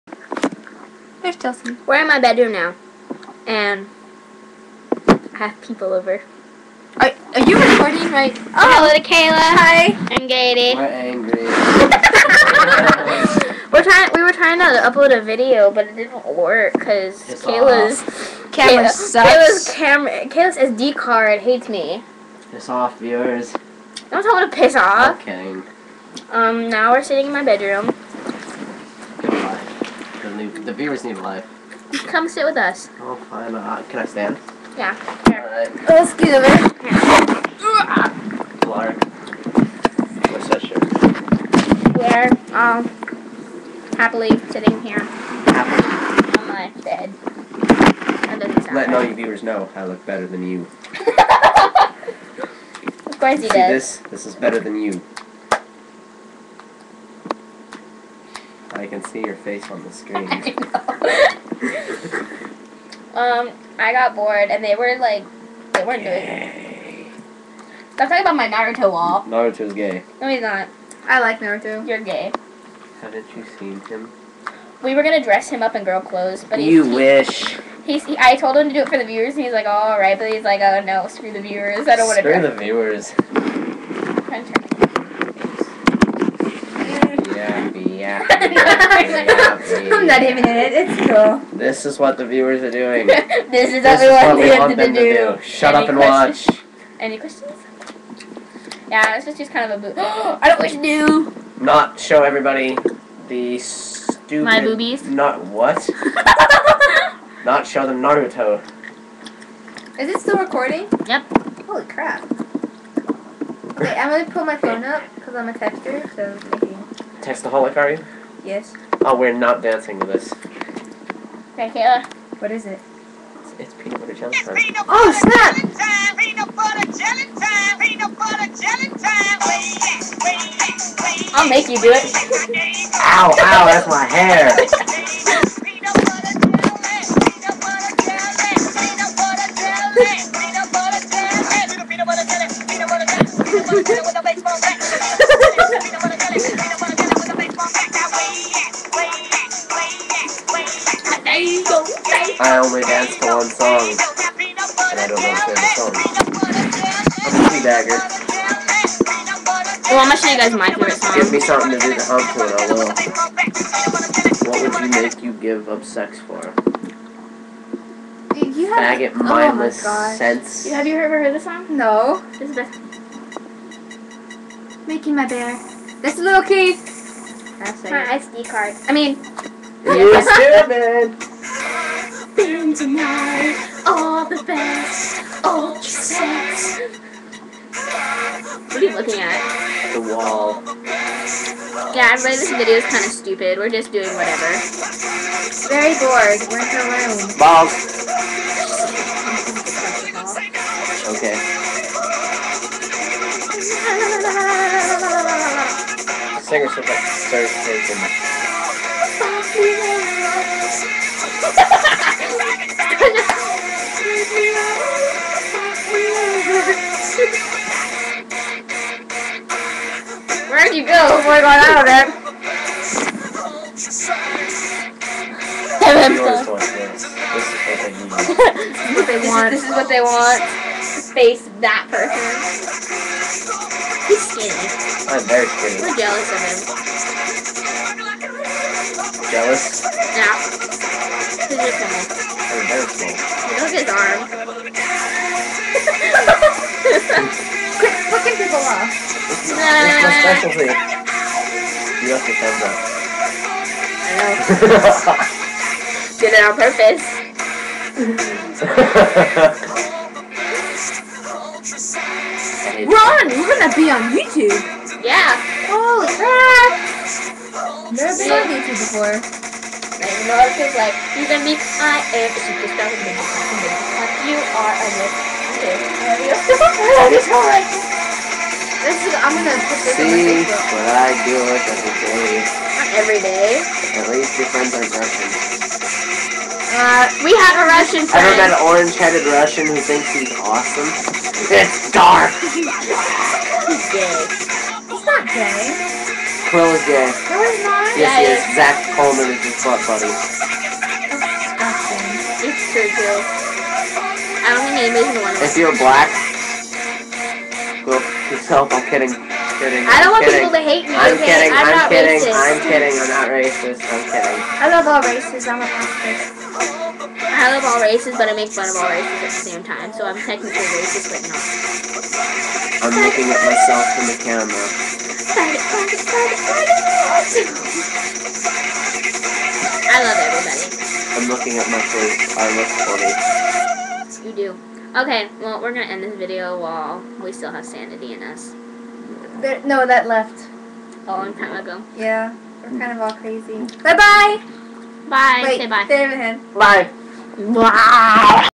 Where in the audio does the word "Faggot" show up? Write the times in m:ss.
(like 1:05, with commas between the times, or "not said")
2:48.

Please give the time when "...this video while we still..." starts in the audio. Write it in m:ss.
5:36.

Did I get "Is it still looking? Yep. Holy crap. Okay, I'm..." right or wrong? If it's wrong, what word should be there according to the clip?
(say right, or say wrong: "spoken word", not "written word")
wrong: "recording", not "looking".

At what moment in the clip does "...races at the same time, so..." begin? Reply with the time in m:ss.
5:18.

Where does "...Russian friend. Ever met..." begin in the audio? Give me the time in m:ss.
4:47.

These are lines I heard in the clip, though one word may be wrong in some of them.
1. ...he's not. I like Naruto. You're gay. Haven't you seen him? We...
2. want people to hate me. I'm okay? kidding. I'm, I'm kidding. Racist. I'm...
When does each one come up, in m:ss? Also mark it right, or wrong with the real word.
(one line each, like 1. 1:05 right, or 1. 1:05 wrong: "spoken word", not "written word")
1. 1:10 right
2. 5:10 right.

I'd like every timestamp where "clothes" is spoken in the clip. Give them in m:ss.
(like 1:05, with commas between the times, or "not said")
1:16.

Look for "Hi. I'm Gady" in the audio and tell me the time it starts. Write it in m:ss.
0:09.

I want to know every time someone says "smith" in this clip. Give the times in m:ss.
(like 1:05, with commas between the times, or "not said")
not said.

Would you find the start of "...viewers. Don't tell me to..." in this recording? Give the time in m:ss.
0:22.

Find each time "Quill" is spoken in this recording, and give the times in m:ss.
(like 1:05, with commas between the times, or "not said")
4:56.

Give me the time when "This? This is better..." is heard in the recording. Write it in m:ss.
0:53.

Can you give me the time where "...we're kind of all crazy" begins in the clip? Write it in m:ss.
5:42.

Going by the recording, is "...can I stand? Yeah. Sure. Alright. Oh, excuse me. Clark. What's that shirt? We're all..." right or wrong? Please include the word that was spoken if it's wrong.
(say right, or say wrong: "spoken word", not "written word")
right.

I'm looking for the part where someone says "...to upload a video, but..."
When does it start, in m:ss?
0:14.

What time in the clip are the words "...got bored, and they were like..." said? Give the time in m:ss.
1:03.